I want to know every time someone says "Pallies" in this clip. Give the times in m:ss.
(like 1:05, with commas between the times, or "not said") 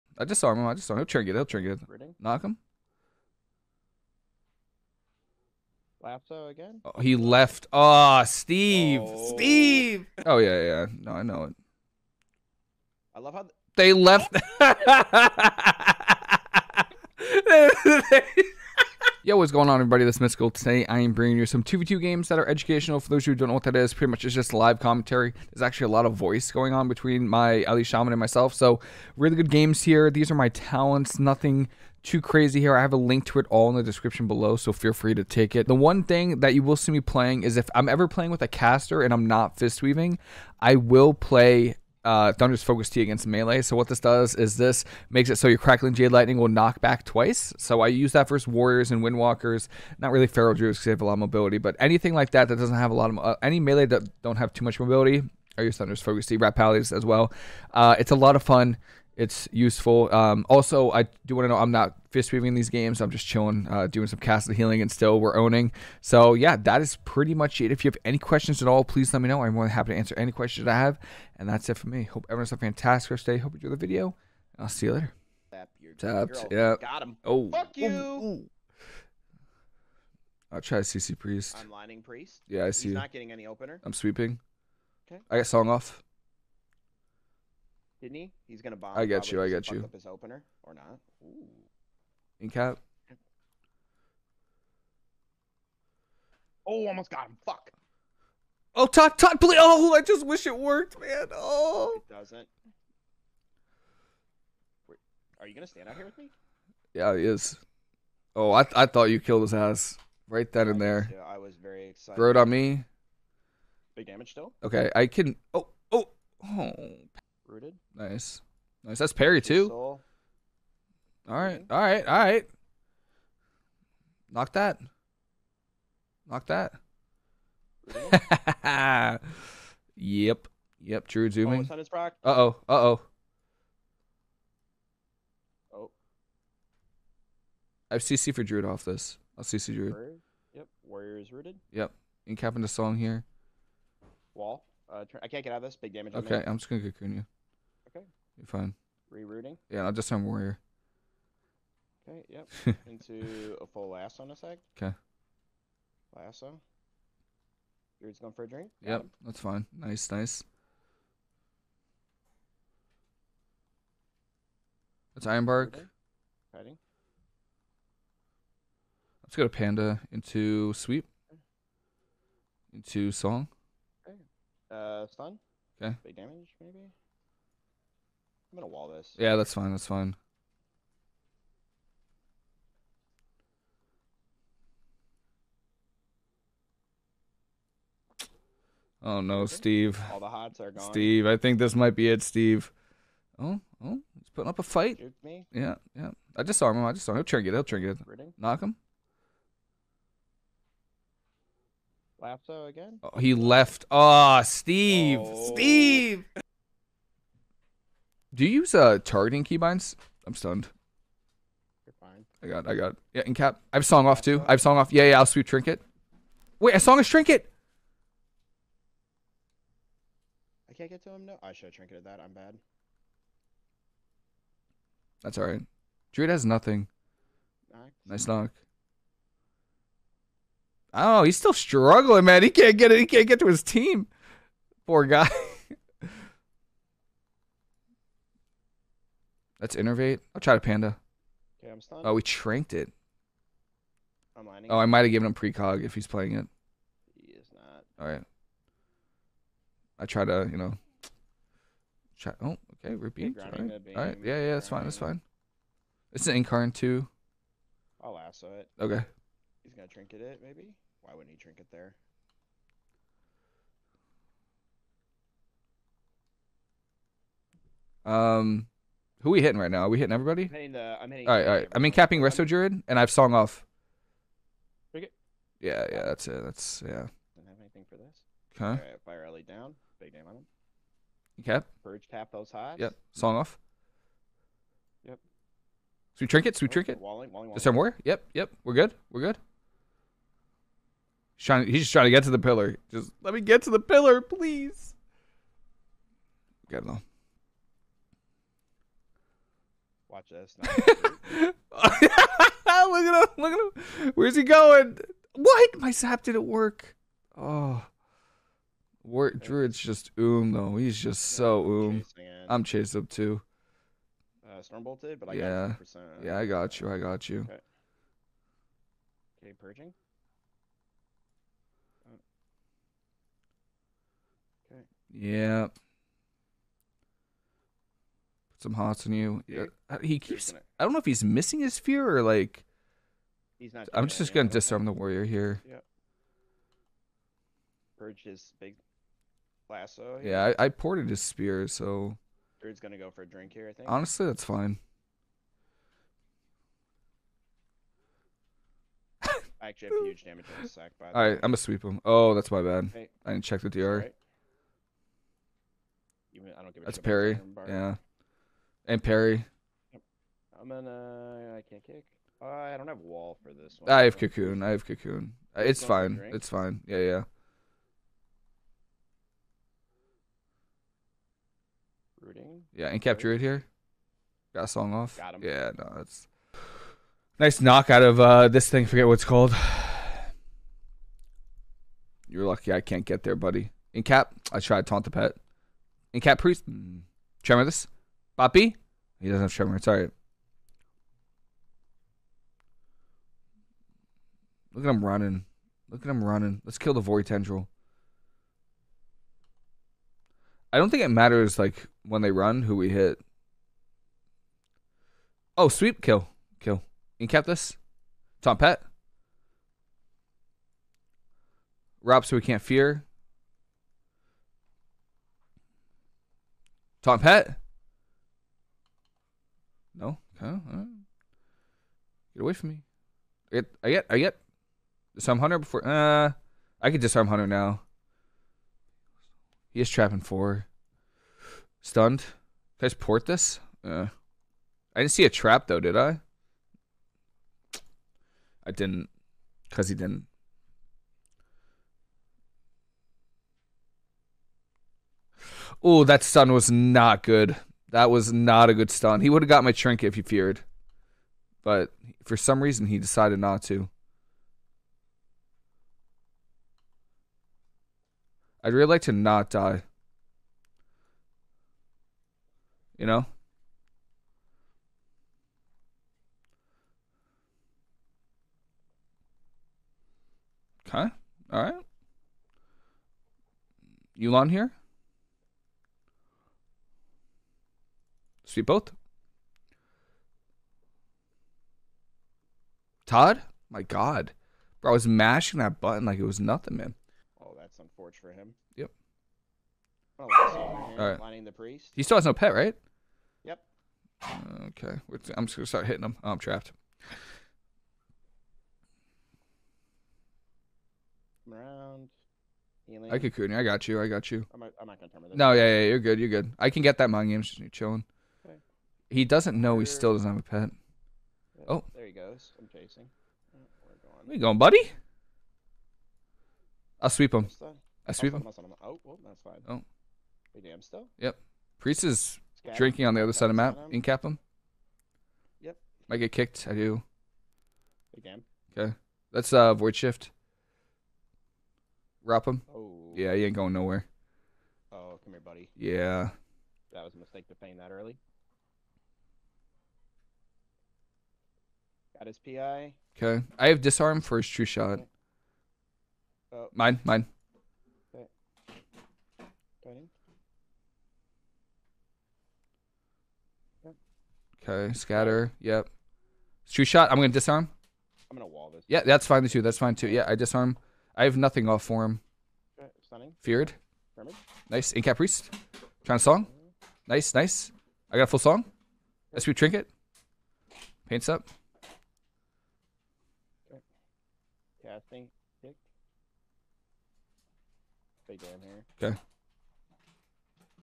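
0:56.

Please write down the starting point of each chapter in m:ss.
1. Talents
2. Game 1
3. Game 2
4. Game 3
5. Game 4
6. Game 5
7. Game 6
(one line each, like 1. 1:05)
1. 0:19
2. 1:15
3. 1:57
4. 3:26
5. 4:37
6. 6:16
7. 8:07.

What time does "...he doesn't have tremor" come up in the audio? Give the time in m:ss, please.
6:29.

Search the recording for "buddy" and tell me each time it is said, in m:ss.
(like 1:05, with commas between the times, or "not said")
6:23, 8:34, 8:55.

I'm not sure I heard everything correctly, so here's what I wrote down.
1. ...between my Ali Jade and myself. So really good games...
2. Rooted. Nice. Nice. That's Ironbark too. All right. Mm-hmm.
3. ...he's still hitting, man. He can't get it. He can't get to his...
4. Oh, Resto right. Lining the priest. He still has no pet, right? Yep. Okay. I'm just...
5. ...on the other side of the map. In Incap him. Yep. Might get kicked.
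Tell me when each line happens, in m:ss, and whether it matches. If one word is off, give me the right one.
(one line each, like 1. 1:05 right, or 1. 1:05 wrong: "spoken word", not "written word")
1. 0:26 wrong: "Shaman", not "Jade"
2. 1:57 wrong: "Perry", not "Ironbark"
3. 3:51 wrong: "struggling", not "hitting"
4. 8:10 wrong: "All", not "Resto"
5. 8:43 right.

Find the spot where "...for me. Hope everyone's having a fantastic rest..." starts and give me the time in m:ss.
1:11.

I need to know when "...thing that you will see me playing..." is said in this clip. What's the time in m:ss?
0:36.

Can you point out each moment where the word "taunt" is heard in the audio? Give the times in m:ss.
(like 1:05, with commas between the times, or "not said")
6:24.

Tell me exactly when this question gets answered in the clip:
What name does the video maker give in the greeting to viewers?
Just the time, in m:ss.
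0:20.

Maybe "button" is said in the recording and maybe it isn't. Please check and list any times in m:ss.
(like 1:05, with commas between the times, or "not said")
8:05.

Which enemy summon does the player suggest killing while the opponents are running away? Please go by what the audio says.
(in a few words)
Void Tendril.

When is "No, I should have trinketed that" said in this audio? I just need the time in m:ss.
3:41.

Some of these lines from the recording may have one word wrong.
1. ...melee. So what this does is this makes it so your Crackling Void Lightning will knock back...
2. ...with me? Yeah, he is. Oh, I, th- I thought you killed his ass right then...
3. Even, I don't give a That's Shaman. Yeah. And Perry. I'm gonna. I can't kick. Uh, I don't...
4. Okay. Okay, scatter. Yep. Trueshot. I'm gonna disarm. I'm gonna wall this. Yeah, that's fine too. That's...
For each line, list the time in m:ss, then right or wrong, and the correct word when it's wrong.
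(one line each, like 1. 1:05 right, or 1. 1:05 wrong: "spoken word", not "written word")
1. 0:43 wrong: "Jade", not "Void"
2. 1:46 right
3. 5:56 wrong: "Perry", not "Shaman"
4. 9:08 right.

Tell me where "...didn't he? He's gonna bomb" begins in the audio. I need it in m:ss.
1:28.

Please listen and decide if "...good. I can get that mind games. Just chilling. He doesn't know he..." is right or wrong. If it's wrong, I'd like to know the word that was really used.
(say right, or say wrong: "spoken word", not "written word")
right.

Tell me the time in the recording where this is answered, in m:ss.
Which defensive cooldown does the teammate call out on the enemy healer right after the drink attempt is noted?
2:45.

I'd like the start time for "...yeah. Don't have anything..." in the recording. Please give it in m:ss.
4:36.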